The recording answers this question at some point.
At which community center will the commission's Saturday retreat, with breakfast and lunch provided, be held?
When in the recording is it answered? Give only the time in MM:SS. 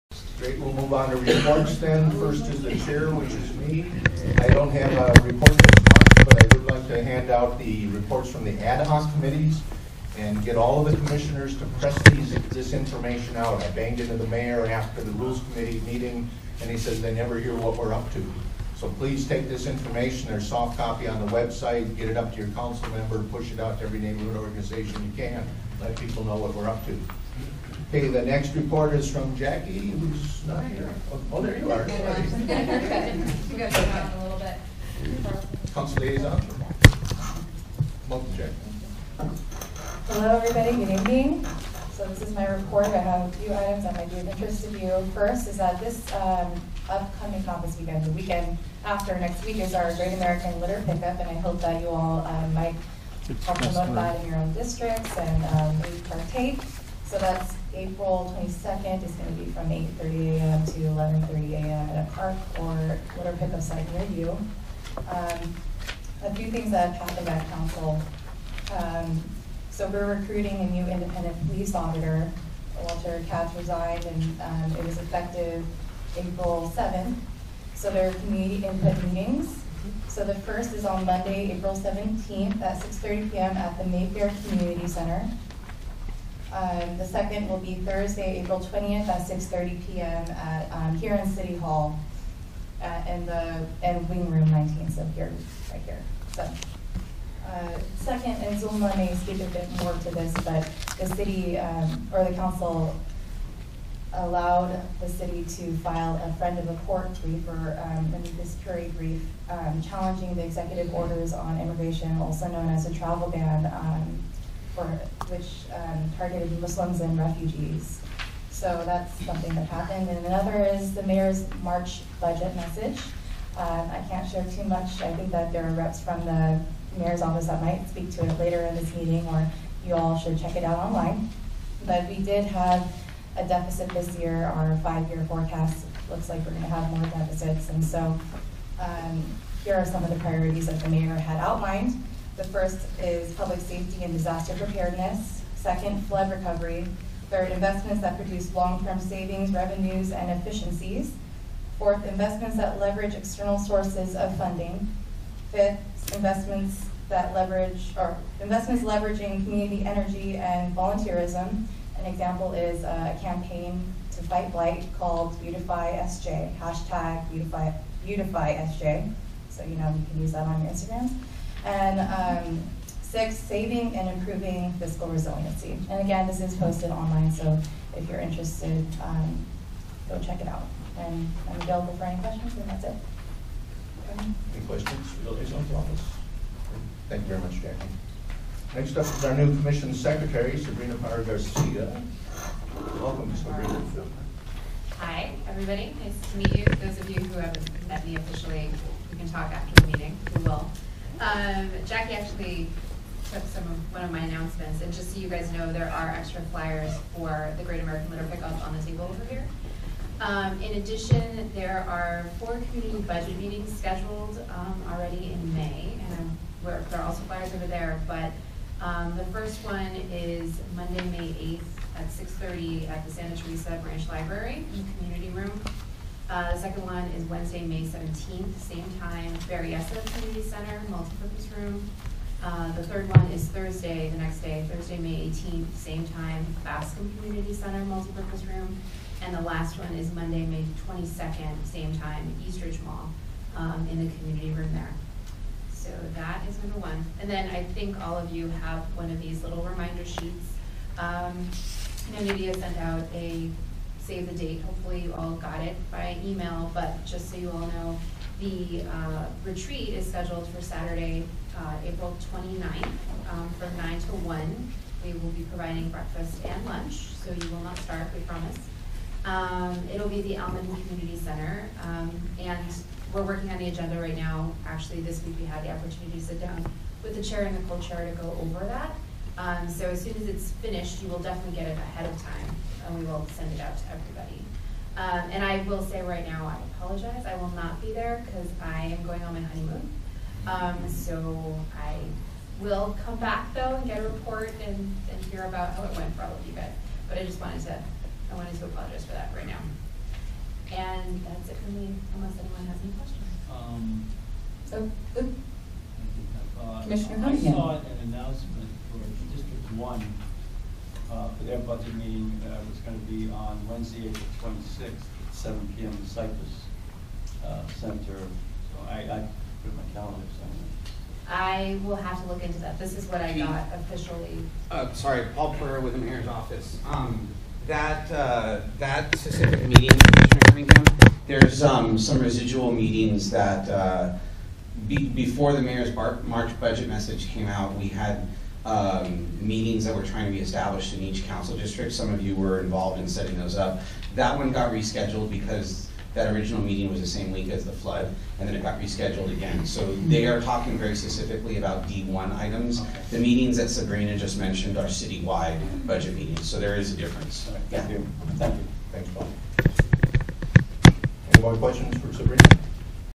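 04:30.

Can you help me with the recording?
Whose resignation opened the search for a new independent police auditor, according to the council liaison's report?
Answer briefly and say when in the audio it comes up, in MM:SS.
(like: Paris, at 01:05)
Walter Katz, at 01:12.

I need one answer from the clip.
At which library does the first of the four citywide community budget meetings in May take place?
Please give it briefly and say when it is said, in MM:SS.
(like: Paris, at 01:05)
Santa Teresa Branch Library, at 03:43.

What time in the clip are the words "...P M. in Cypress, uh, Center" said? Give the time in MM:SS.
05:15.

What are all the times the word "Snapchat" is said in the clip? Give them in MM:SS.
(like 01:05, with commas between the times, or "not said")
not said.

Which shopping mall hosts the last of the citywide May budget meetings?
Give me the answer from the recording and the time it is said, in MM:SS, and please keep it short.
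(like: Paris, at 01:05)
Eastridge Mall, at 04:02.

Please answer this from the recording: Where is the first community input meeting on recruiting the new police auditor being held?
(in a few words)
Mayfair Community Center.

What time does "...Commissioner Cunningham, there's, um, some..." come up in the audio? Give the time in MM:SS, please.
05:29.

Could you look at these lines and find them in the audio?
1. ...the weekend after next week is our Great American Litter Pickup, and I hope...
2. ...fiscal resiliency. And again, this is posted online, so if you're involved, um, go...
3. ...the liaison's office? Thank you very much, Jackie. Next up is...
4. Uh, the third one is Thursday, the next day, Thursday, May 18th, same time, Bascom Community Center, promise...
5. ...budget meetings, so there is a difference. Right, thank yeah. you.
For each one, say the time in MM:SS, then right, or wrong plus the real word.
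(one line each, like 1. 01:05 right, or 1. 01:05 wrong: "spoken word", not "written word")
1. 00:48 right
2. 02:54 wrong: "interested", not "involved"
3. 03:05 right
4. 03:52 wrong: "multipurpose", not "promise"
5. 05:55 right.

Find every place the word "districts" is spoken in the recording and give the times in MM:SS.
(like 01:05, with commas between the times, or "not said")
00:54, 05:09, 05:41.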